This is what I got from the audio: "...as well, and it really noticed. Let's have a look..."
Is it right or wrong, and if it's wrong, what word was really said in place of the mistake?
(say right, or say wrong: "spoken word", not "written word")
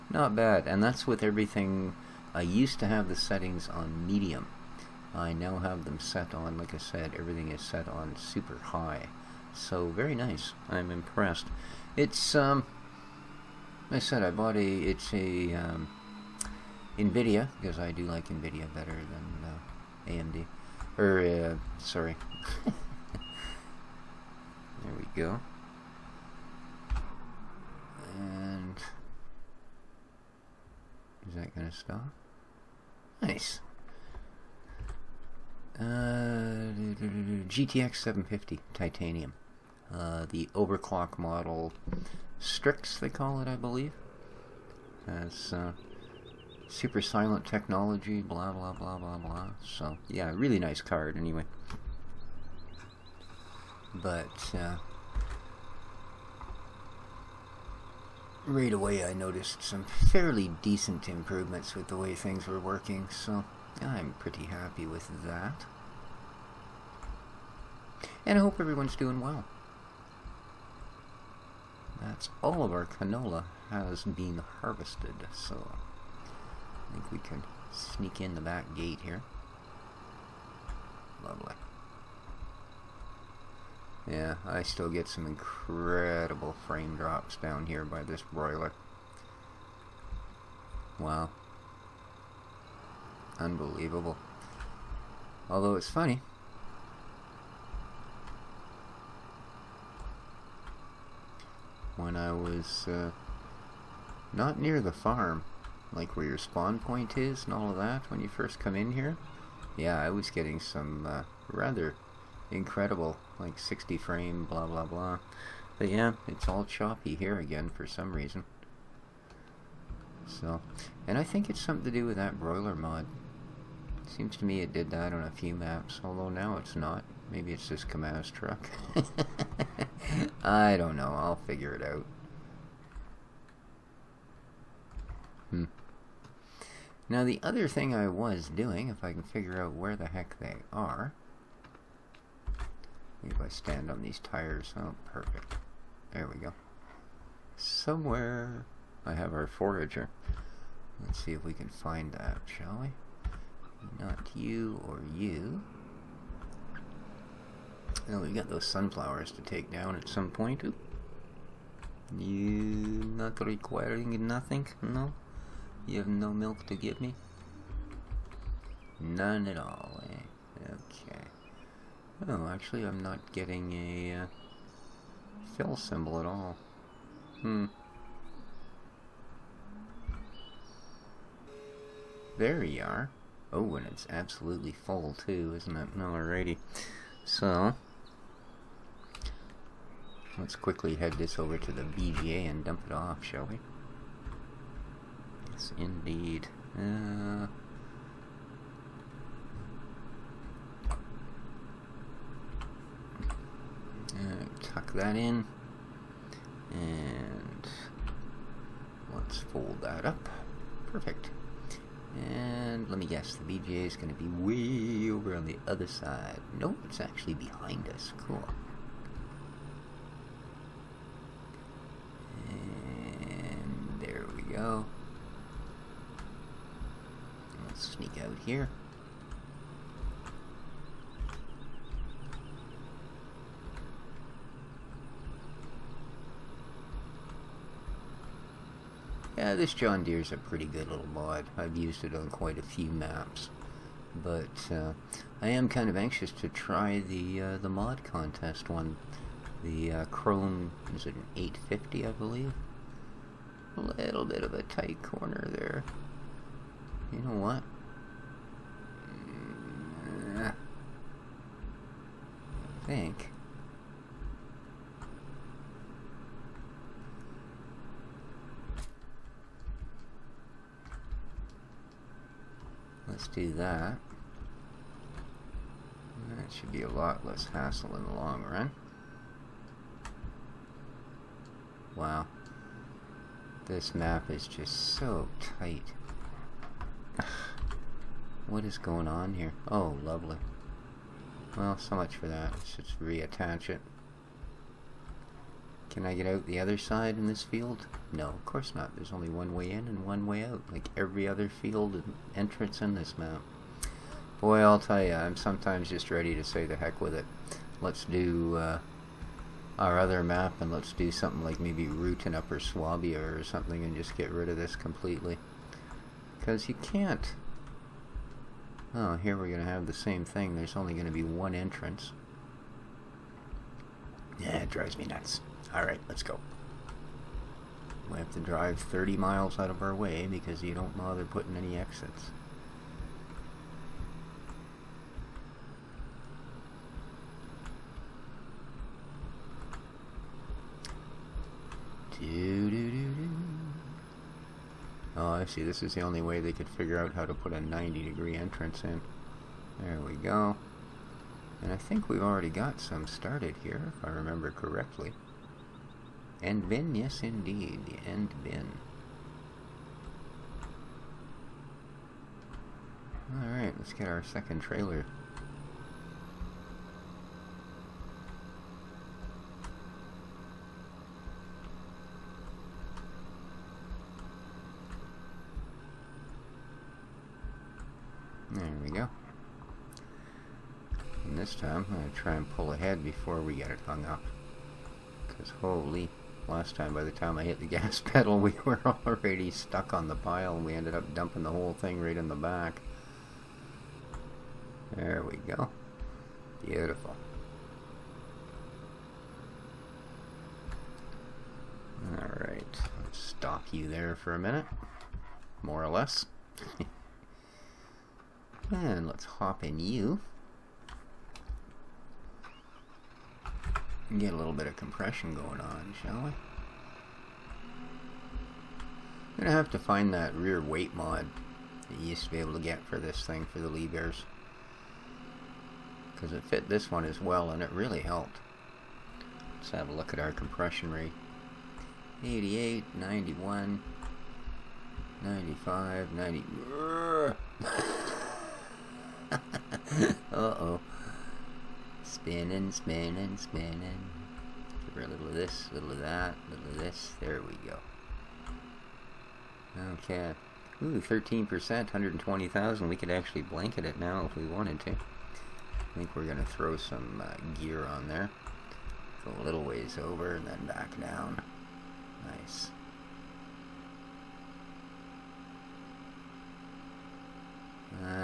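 wrong: "helped", not "noticed".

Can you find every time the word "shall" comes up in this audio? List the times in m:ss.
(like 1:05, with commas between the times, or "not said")
2:32, 3:13, 6:56.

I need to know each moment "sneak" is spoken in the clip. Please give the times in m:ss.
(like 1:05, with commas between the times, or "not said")
1:17, 3:47.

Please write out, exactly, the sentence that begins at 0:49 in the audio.
So, yeah, really nice card anyway.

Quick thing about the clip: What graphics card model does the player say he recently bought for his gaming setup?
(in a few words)
GTX 750 Titanium.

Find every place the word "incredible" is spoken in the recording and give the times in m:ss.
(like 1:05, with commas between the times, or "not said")
1:25, 1:52.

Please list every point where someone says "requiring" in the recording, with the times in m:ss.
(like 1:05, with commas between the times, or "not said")
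2:43.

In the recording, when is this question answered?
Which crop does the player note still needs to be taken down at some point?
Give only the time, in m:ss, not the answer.
2:38.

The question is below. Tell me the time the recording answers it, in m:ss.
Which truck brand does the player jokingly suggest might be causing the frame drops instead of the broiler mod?
2:07.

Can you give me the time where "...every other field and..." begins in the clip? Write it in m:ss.
5:00.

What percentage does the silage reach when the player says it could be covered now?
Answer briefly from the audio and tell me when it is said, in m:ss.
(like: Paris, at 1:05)
13%, at 7:30.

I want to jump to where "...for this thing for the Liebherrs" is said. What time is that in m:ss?
7:02.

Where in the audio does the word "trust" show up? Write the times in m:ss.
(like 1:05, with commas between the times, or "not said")
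not said.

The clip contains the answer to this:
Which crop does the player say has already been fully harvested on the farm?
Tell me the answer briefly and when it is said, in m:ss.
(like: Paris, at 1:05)
Canola, at 1:12.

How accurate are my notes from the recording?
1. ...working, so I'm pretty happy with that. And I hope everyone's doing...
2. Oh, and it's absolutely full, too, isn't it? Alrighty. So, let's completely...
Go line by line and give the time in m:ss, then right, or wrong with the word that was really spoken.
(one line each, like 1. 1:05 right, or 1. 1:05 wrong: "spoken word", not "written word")
1. 1:02 right
2. 3:03 wrong: "quickly", not "completely".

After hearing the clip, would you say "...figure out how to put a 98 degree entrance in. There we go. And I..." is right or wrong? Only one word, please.
wrong.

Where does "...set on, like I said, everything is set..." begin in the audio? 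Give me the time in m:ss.
0:05.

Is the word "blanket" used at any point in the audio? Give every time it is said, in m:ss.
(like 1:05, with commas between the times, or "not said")
7:33.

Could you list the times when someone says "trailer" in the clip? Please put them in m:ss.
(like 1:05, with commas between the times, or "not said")
6:04.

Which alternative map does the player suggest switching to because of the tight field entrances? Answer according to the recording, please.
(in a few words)
Upper Swabia.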